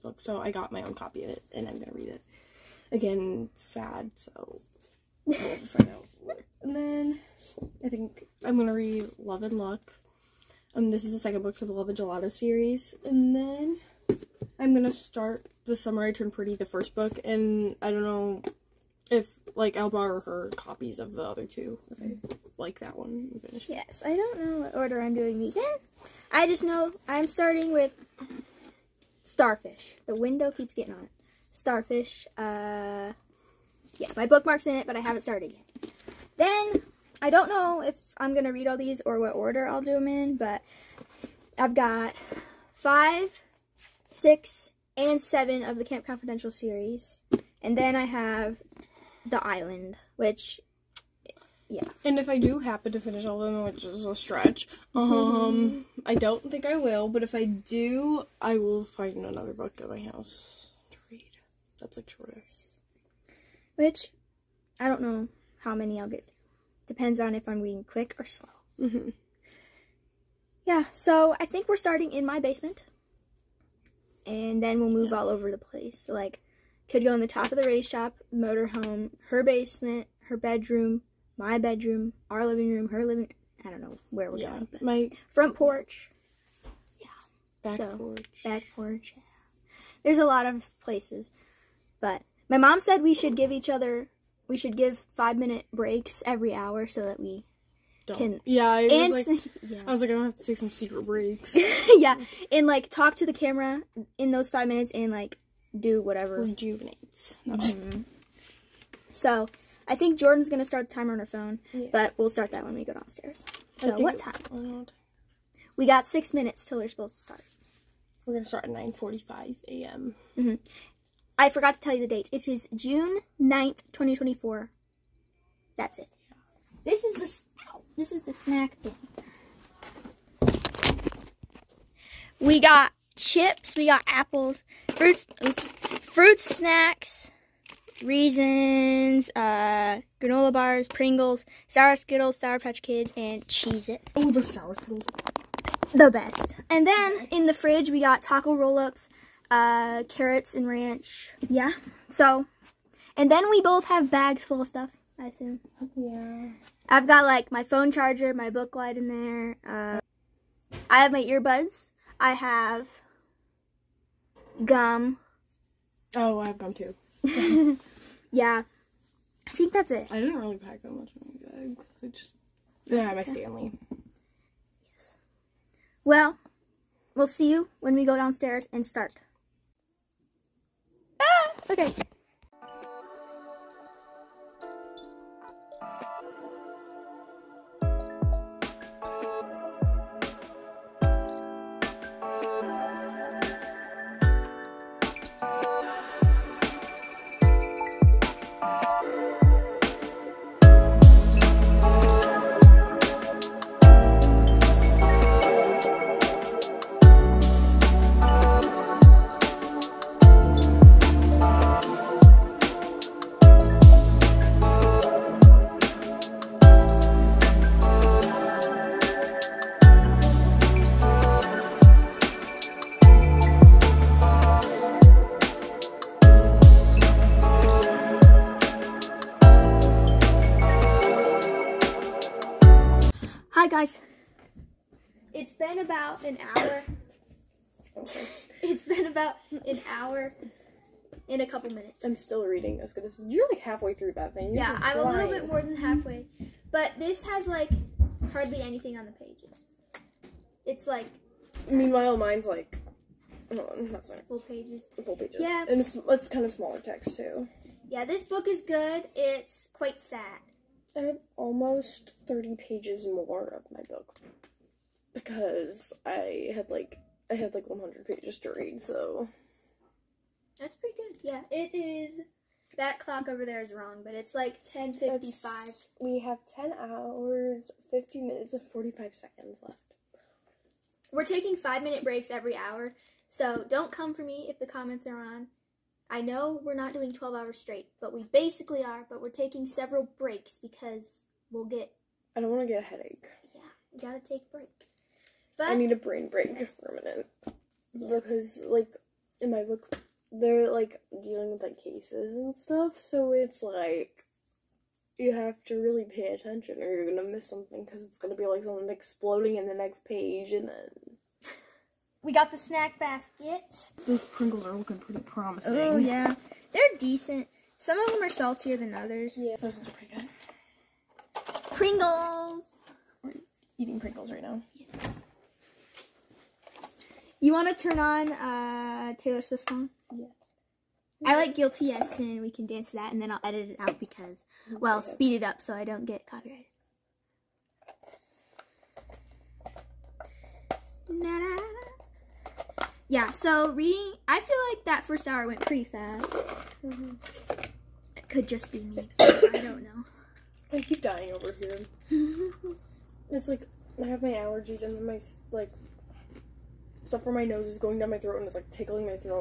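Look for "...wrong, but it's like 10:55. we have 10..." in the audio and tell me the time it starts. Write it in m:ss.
4:33.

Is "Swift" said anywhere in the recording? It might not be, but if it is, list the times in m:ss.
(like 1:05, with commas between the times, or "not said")
5:29.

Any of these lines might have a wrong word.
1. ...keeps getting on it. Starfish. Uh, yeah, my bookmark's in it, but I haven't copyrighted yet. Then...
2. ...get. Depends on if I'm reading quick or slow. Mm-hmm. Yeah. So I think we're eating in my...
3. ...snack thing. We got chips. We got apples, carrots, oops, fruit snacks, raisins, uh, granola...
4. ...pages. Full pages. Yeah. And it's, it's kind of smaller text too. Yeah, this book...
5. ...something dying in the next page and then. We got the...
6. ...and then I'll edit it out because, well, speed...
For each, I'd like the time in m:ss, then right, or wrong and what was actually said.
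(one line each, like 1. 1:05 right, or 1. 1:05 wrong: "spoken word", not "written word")
1. 0:30 wrong: "started", not "copyrighted"
2. 1:06 wrong: "starting", not "eating"
3. 2:08 wrong: "fruits", not "carrots"
4. 4:14 right
5. 5:08 wrong: "exploding", not "dying"
6. 5:33 right.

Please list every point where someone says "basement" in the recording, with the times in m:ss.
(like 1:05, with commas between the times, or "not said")
1:12, 1:19.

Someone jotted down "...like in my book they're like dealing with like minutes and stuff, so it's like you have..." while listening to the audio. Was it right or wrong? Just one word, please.
wrong.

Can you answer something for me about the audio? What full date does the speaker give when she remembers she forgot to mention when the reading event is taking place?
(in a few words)
June 9th, 2024.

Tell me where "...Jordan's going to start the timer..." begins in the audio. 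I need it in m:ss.
1:50.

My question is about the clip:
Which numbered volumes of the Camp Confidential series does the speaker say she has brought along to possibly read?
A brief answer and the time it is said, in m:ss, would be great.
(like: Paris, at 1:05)
5, 6, and 7, at 0:42.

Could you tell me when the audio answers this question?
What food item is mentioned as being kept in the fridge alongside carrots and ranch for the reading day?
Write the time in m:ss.
2:28.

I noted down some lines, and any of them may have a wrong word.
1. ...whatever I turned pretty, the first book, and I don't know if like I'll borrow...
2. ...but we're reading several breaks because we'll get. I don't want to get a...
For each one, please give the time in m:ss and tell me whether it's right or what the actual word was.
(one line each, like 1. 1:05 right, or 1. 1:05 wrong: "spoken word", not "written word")
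1. 0:15 wrong: "summer", not "whatever"
2. 4:49 wrong: "taking", not "reading".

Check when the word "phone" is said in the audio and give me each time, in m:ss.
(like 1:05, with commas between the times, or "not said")
1:51, 2:37.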